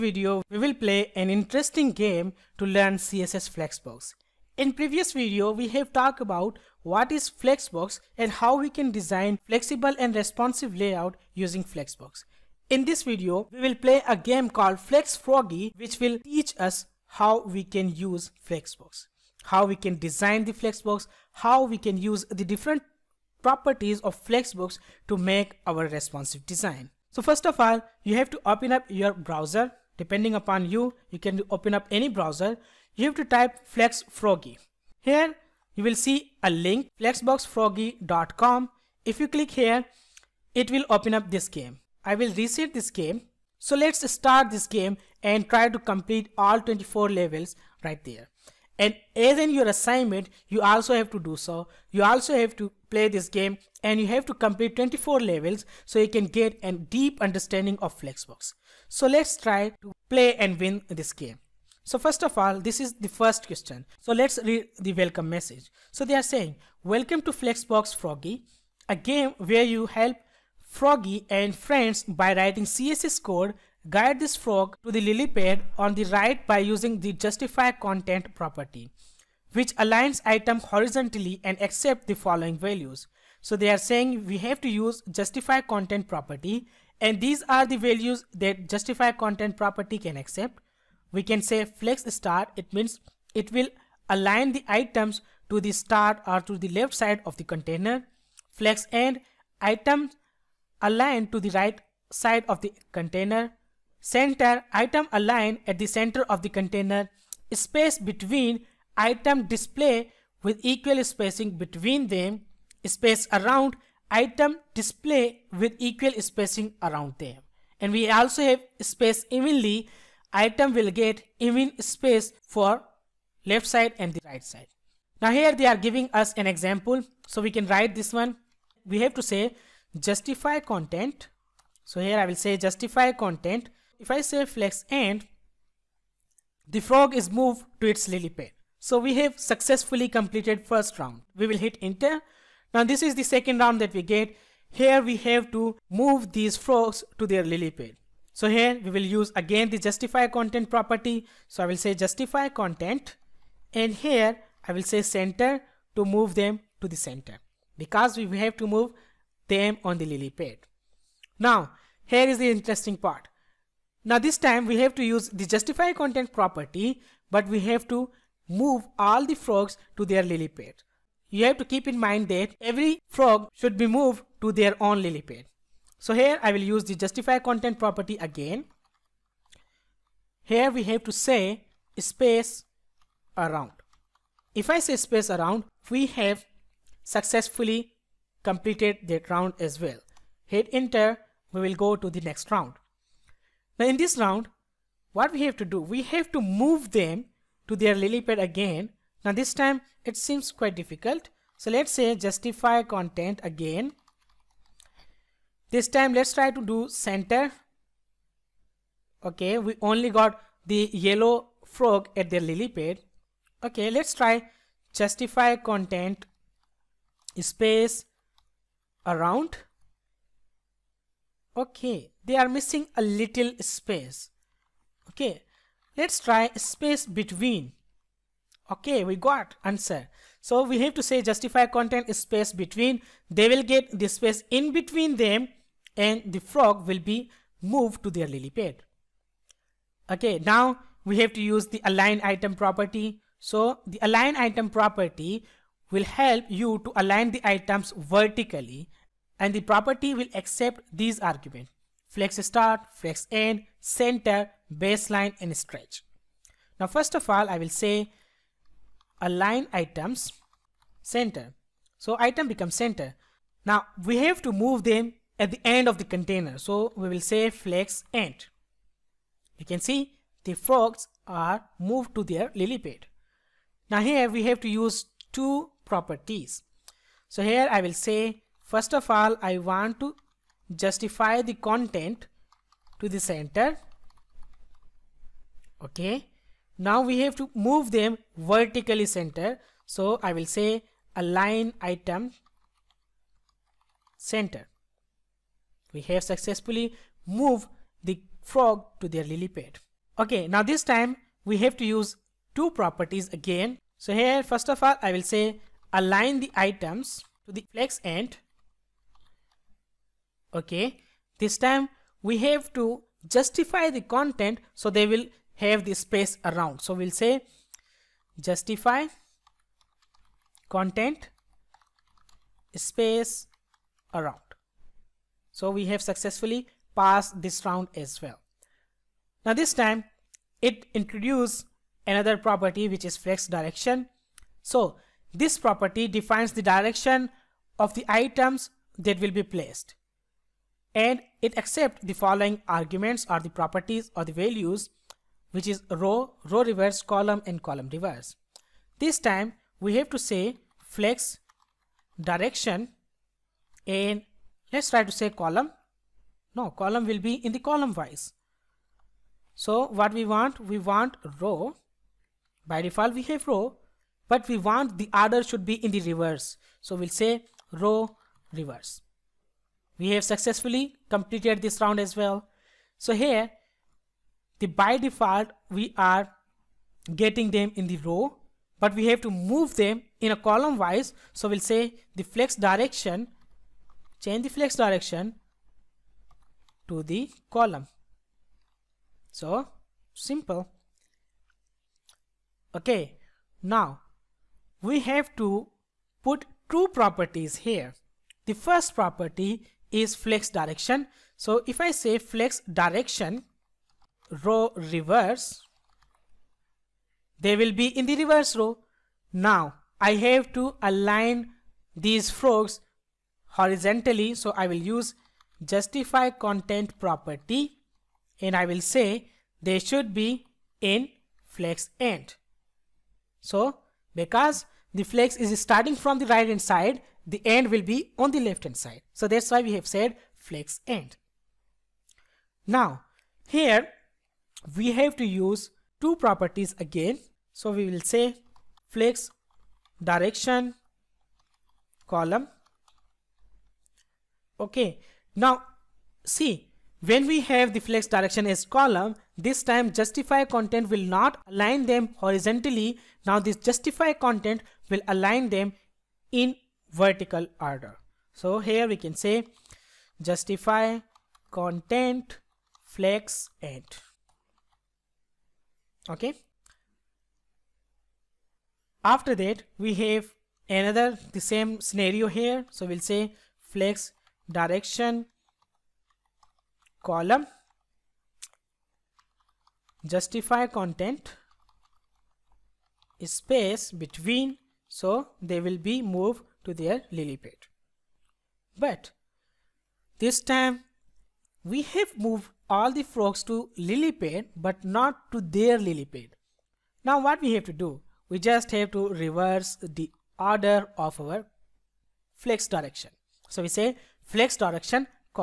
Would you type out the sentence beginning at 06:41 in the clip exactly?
So if I say flex direction row reverse, they will be in the reverse row.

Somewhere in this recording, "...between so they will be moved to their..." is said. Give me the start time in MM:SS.
08:03.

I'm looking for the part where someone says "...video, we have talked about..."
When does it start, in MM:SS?
00:05.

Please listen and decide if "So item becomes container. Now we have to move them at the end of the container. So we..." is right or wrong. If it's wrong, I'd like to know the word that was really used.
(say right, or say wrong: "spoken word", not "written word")
wrong: "center", not "container".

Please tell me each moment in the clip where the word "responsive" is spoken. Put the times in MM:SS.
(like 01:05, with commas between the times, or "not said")
00:10, 00:25.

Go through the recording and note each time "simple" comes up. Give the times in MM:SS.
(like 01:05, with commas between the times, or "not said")
06:30.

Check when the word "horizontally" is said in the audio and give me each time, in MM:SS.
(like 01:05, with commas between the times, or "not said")
01:20, 06:53, 07:32.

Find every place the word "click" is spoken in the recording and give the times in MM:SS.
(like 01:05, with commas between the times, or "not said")
00:39.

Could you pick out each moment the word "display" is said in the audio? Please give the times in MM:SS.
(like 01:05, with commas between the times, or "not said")
01:49, 01:54.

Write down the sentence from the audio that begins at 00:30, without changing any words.
Depending upon you, you can open up any browser.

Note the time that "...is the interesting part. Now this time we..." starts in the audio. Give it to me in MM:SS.
02:42.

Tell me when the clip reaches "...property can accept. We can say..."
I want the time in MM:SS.
01:29.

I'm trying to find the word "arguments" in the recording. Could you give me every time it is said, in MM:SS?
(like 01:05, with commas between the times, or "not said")
04:11, 05:42.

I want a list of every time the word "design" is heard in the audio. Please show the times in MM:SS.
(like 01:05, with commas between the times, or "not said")
00:08, 00:19, 00:26.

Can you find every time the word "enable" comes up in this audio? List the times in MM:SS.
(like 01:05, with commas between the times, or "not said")
not said.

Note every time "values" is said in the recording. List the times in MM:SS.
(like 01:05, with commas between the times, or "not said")
01:22, 01:27, 05:44.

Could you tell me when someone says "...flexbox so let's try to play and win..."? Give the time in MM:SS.
00:57.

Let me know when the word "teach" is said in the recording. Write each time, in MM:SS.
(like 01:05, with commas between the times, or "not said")
00:16.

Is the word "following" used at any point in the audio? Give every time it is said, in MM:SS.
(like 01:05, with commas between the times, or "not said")
01:22, 05:42.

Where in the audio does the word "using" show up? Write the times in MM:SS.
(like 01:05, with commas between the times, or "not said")
00:11, 01:16.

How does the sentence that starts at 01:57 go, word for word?
And we also have space evenly, item will get even space for left side and the right side.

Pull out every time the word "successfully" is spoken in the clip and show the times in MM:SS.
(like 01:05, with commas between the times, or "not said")
02:19, 03:07, 04:56, 05:26, 06:10.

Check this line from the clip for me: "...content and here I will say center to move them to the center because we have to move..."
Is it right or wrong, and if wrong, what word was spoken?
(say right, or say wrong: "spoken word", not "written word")
right.